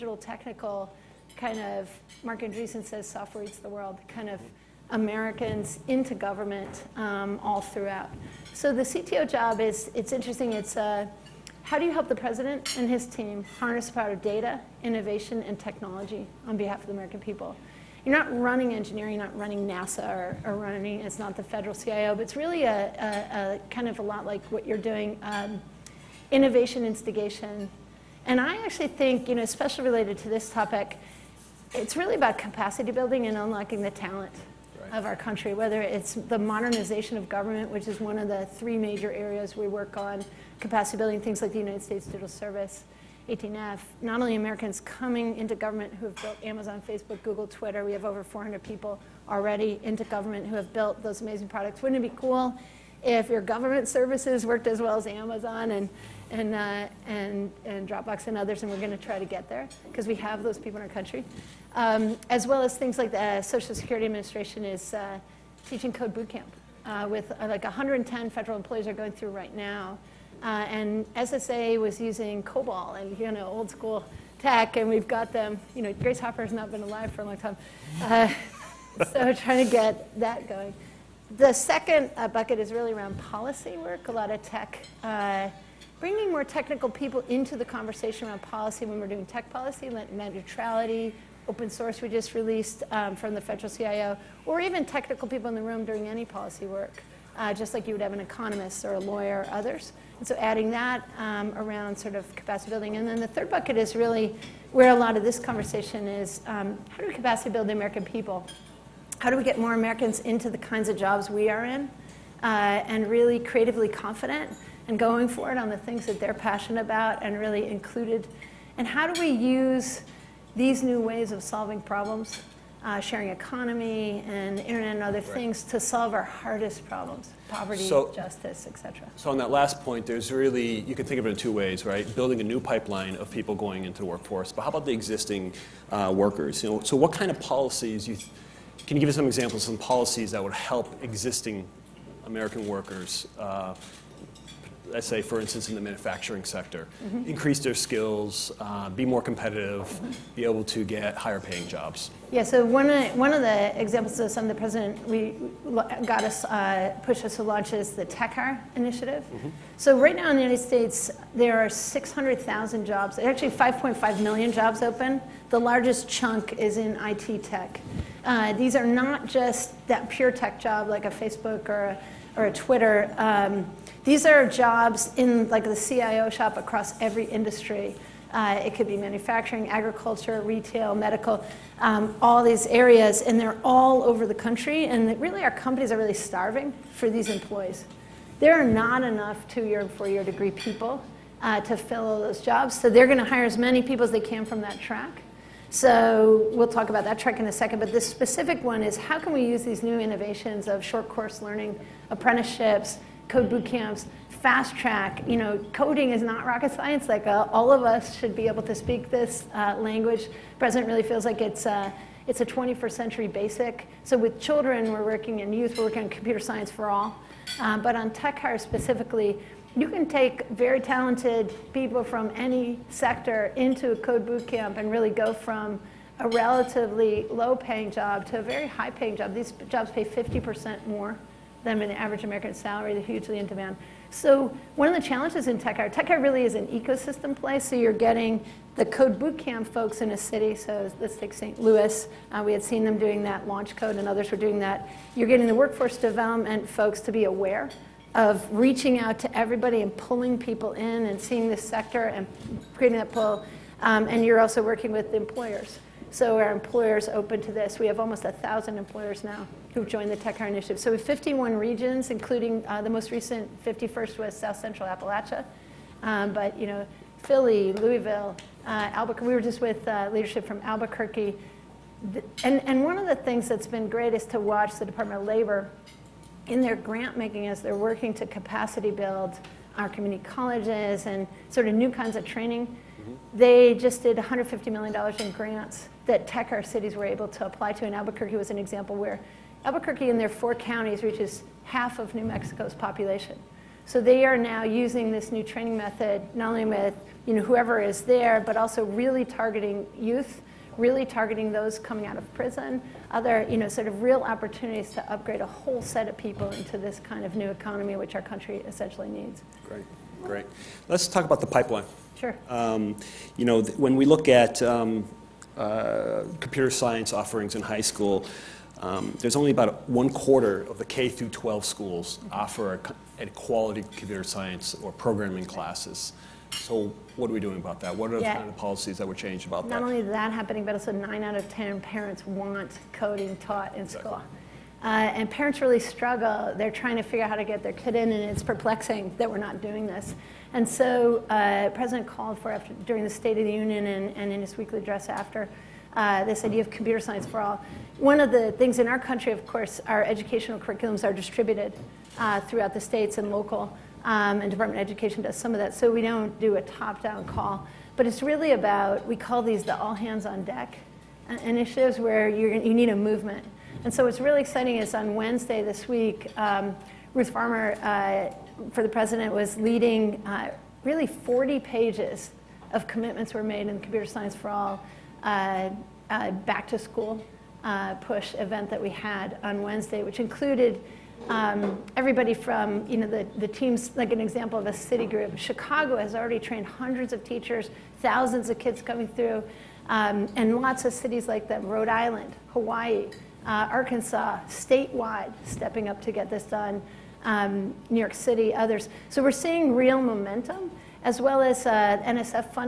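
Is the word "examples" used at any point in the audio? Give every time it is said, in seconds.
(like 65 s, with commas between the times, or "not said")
139 s, 153 s, 288 s, 384 s.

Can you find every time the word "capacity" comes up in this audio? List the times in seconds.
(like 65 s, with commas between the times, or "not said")
32 s, 40 s, 102 s, 107 s, 278 s.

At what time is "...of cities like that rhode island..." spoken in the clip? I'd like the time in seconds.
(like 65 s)
390 s.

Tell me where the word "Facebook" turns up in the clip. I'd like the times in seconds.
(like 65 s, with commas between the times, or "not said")
46 s, 171 s.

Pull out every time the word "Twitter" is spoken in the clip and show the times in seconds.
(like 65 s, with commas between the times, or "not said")
47 s, 172 s.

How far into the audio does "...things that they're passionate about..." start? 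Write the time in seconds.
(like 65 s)
115 s.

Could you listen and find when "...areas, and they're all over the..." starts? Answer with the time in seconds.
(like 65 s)
182 s.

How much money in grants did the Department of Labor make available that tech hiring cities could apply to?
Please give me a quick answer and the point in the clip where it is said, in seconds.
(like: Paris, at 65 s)
$150 million, at 284 s.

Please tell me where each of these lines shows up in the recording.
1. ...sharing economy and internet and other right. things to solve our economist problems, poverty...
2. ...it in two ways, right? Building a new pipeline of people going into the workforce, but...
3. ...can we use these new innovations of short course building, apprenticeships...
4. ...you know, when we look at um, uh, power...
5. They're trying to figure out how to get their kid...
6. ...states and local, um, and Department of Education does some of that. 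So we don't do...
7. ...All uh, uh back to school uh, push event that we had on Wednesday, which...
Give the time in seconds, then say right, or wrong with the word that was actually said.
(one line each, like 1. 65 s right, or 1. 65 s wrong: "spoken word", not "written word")
1. 122 s wrong: "hardest", not "economist"
2. 131 s right
3. 199 s wrong: "learning", not "building"
4. 313 s wrong: "computer", not "power"
5. 336 s right
6. 352 s right
7. 374 s right.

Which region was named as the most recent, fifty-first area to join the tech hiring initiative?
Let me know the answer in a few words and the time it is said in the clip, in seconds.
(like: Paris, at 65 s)
South Central Appalachia, at 264 s.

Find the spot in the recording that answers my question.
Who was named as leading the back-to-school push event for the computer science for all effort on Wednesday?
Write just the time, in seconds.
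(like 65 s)
367 s.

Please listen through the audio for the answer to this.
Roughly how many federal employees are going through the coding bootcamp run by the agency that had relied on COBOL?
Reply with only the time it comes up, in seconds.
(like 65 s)
67 s.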